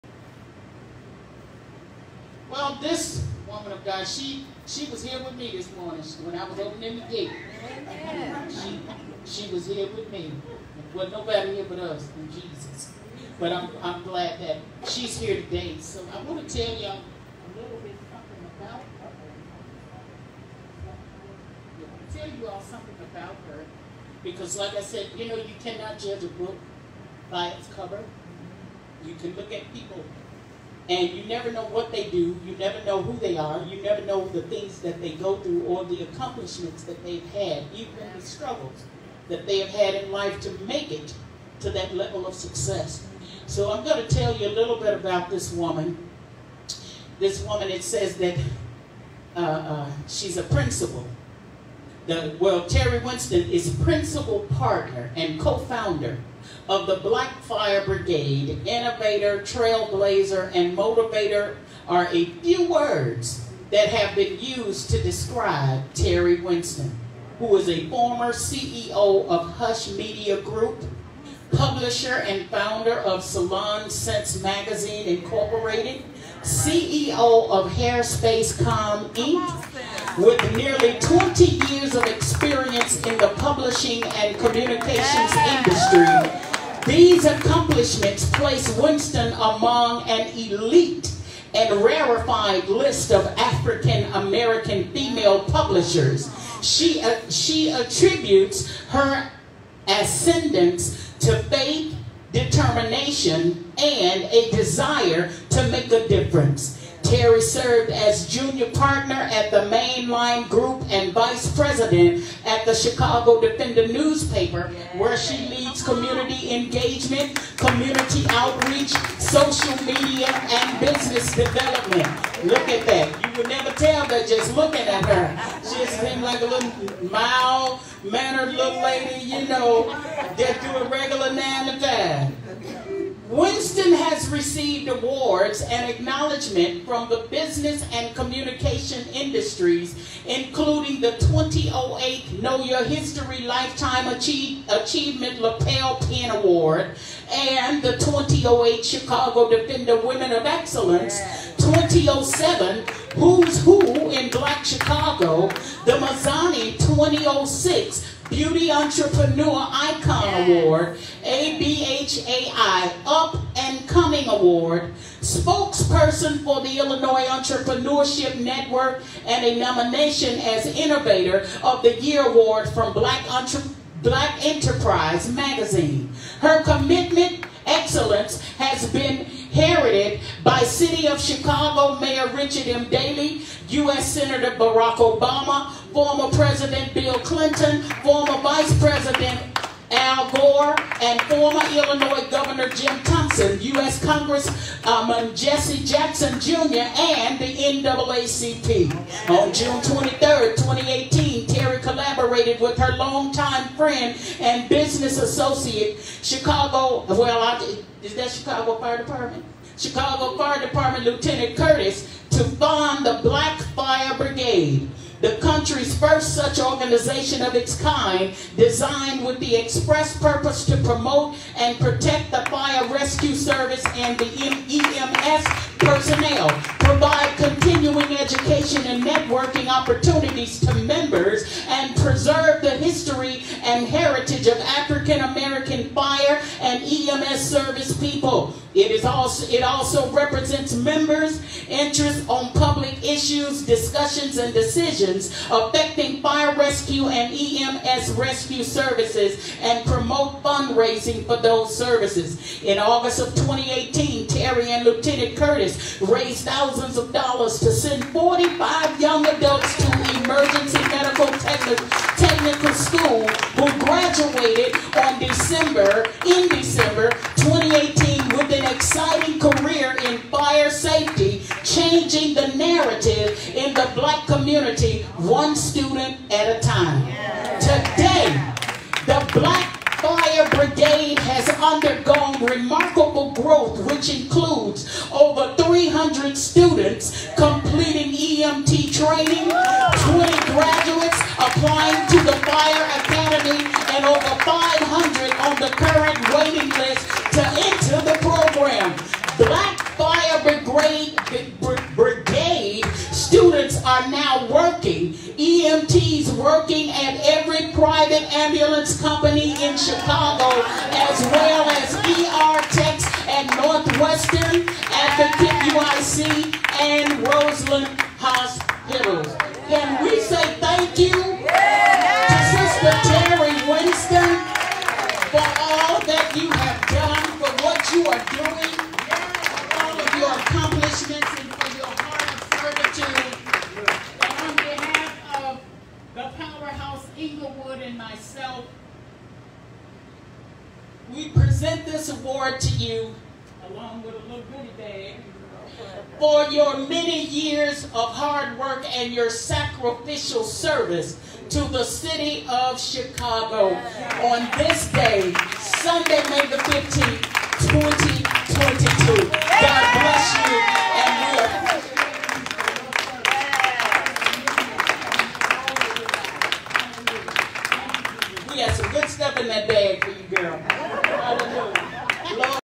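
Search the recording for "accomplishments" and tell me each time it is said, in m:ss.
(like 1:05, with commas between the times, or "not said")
0:36, 1:27.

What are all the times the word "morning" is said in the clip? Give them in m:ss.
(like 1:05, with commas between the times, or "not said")
0:05.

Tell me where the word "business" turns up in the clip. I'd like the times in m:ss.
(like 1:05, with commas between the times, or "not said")
2:00, 2:17, 3:24.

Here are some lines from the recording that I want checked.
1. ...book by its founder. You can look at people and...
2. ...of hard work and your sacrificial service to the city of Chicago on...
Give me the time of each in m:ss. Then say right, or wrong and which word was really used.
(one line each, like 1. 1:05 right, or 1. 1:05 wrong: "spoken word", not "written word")
1. 0:26 wrong: "cover", not "founder"
2. 5:47 right.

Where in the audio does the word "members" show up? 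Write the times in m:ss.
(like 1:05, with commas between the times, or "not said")
3:50, 4:00.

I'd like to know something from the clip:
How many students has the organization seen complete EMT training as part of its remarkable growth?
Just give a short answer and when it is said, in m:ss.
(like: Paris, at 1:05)
Over 300, at 4:45.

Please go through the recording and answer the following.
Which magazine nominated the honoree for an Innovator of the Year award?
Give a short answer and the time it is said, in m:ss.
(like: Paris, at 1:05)
Black Enterprise Magazine, at 2:54.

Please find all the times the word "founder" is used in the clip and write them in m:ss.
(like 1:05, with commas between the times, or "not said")
0:55, 1:12.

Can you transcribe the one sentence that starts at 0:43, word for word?
So I'm going to tell you a little bit about this woman.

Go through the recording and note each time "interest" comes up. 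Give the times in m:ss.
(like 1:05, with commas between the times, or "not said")
4:01.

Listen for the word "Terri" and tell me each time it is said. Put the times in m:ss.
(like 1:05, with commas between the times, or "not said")
0:52, 1:05, 1:47, 3:21, 4:14.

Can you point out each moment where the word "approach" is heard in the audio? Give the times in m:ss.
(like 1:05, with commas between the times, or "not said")
not said.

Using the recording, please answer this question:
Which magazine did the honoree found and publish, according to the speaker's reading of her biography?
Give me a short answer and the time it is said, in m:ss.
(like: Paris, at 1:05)
Salon Sense Magazine, at 1:13.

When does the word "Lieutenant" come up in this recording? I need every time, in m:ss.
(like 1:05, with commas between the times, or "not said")
3:31, 4:14.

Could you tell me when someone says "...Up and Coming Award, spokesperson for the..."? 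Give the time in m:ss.
2:43.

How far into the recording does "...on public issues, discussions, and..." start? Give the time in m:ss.
4:02.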